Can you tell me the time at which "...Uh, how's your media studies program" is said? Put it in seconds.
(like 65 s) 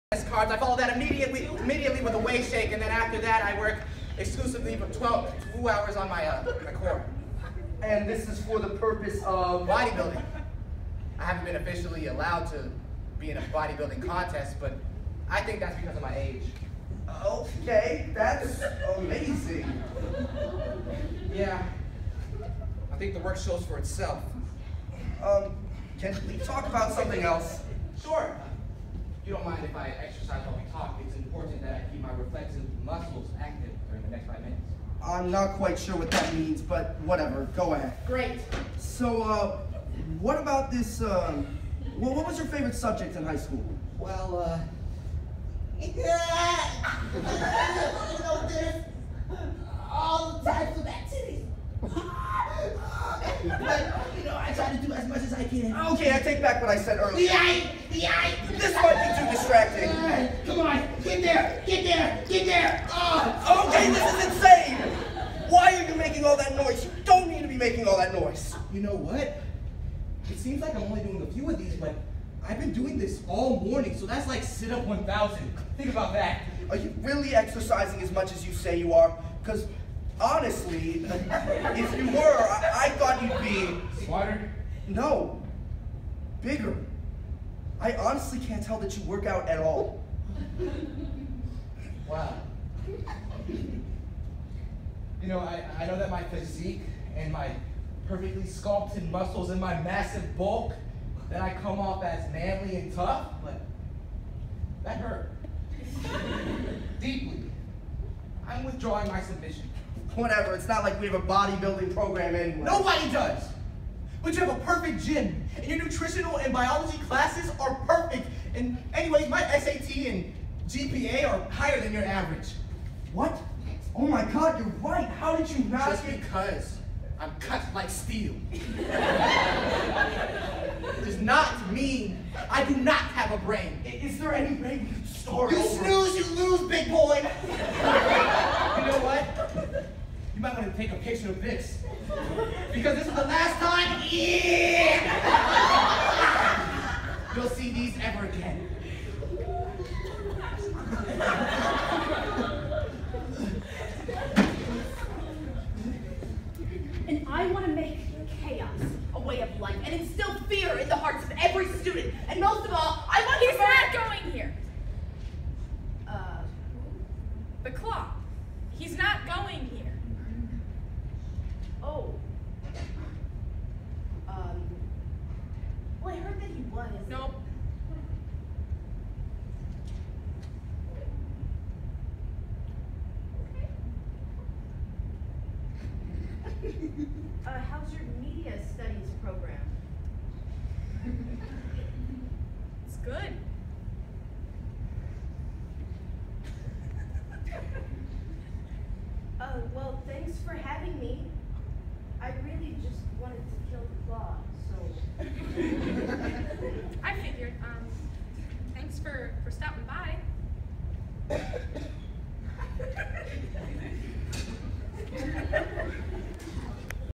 187 s.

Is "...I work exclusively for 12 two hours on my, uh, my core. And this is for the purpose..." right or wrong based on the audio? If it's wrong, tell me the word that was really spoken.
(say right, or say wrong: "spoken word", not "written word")
right.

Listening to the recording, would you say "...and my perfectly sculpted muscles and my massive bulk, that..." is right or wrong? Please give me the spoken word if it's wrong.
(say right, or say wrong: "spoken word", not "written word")
right.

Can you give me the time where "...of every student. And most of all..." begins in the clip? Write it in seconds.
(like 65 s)
161 s.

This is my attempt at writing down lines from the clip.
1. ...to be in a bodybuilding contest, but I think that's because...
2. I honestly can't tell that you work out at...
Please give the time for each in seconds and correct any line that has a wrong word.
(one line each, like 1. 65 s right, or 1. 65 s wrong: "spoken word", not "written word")
1. 12 s right
2. 87 s right.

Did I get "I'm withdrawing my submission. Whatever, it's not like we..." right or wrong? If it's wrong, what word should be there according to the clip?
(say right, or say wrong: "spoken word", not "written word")
right.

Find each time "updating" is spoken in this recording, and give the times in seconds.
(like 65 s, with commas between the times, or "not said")
not said.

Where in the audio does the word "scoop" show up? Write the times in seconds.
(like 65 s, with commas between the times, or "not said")
not said.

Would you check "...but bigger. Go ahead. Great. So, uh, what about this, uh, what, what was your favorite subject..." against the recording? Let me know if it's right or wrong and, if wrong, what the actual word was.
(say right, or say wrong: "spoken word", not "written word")
wrong: "whatever", not "bigger".